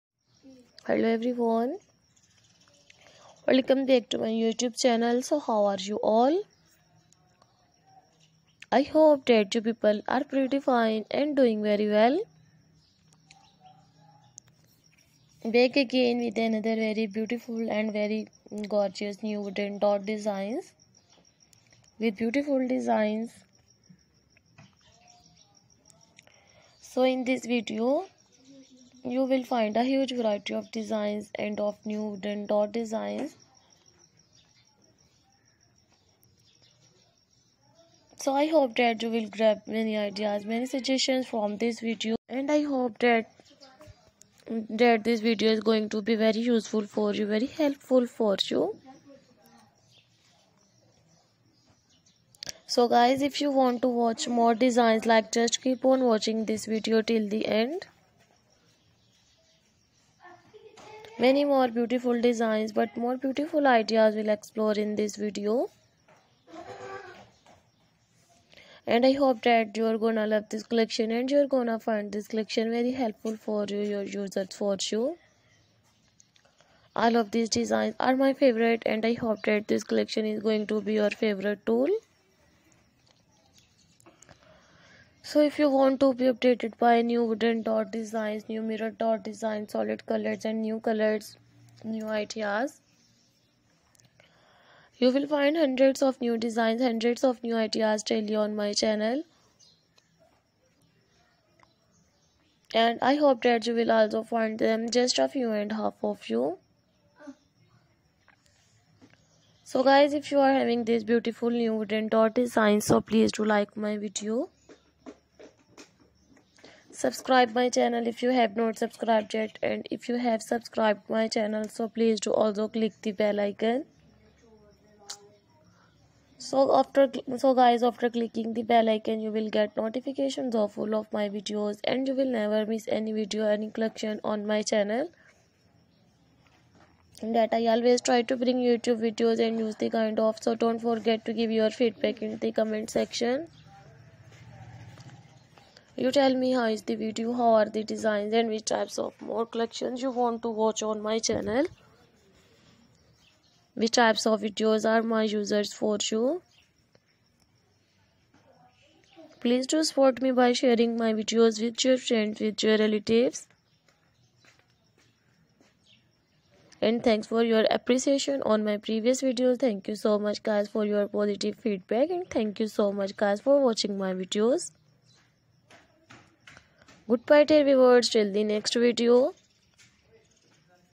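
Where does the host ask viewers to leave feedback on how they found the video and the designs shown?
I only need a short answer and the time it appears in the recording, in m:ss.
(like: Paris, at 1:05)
Comment section, at 2:22.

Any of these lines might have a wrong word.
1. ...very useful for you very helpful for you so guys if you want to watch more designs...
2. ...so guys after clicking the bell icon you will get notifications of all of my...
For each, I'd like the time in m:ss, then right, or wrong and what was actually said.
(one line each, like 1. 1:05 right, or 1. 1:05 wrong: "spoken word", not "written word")
1. 0:46 right
2. 2:07 right.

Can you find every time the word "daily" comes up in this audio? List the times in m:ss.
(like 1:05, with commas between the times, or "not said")
1:38.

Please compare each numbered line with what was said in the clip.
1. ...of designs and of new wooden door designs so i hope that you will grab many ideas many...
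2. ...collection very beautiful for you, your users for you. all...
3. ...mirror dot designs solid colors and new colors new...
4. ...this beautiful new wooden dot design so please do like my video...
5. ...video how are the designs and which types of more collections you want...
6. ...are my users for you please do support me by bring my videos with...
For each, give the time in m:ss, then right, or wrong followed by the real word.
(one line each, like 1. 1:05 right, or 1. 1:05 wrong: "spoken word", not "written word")
1. 0:30 right
2. 1:12 wrong: "helpful", not "beautiful"
3. 1:28 right
4. 1:50 right
5. 2:26 right
6. 2:34 wrong: "sharing", not "bring".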